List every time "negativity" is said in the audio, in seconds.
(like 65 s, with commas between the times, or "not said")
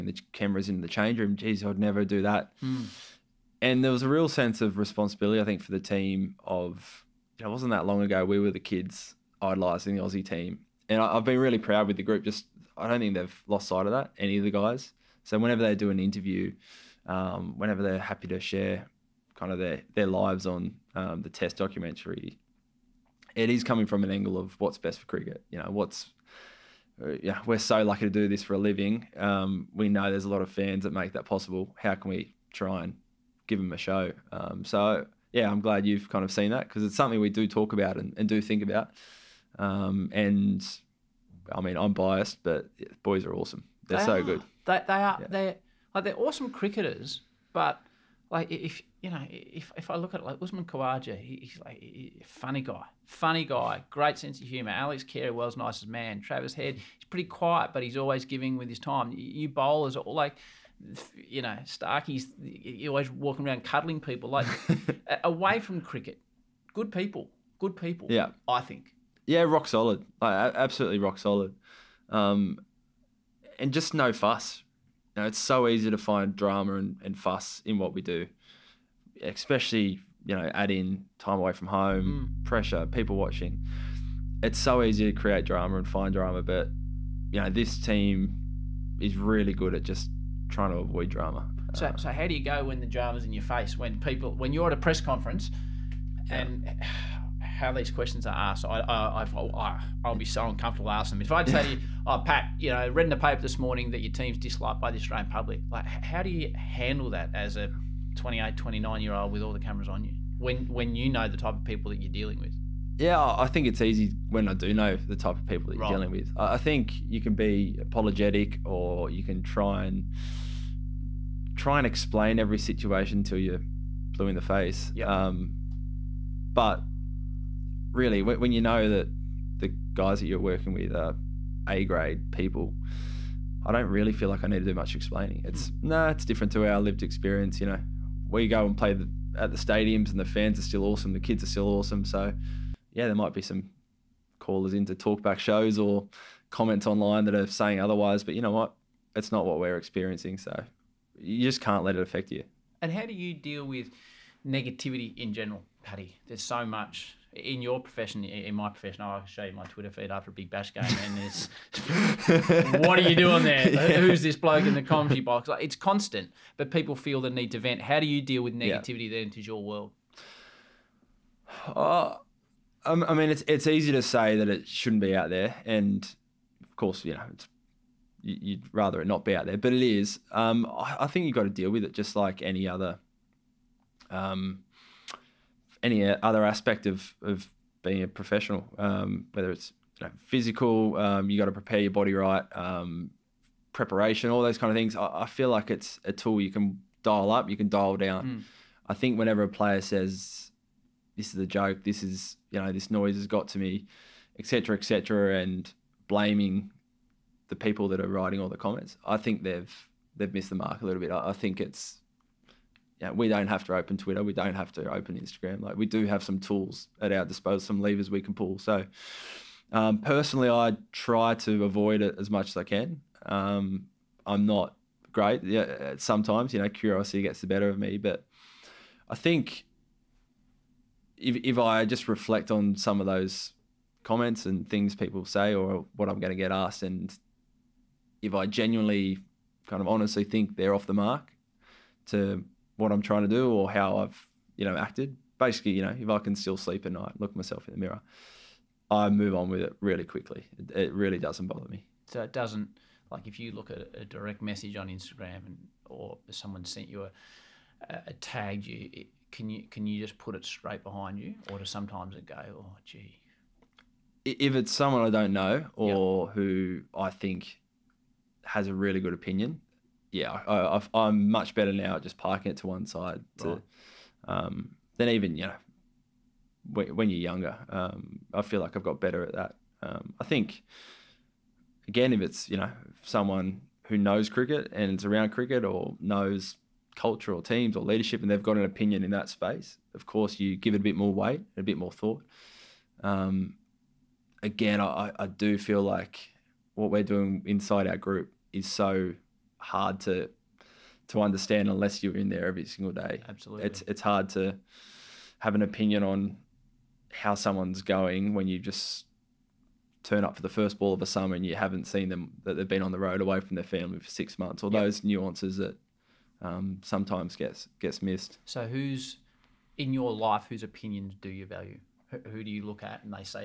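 154 s, 168 s.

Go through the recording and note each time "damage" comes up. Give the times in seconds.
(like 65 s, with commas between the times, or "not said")
not said.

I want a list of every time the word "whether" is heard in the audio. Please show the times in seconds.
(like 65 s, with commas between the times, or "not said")
189 s.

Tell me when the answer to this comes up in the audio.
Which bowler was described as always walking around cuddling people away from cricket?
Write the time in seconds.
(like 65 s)
61 s.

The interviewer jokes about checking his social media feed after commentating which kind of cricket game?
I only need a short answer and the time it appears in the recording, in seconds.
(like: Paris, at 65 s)
Big Bash, at 160 s.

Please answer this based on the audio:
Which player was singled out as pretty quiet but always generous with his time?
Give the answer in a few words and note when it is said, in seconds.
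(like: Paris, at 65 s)
Travis Head, at 56 s.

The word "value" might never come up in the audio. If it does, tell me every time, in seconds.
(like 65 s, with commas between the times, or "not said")
321 s.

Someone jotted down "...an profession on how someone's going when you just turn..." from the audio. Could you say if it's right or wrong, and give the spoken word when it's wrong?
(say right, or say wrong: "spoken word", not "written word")
wrong: "opinion", not "profession".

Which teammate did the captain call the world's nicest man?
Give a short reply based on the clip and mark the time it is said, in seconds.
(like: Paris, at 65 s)
Alex Carey, at 54 s.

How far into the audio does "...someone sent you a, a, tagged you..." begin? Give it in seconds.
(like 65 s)
256 s.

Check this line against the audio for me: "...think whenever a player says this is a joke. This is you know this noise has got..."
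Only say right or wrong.
right.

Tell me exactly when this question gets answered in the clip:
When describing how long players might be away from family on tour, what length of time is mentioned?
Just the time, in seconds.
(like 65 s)
314 s.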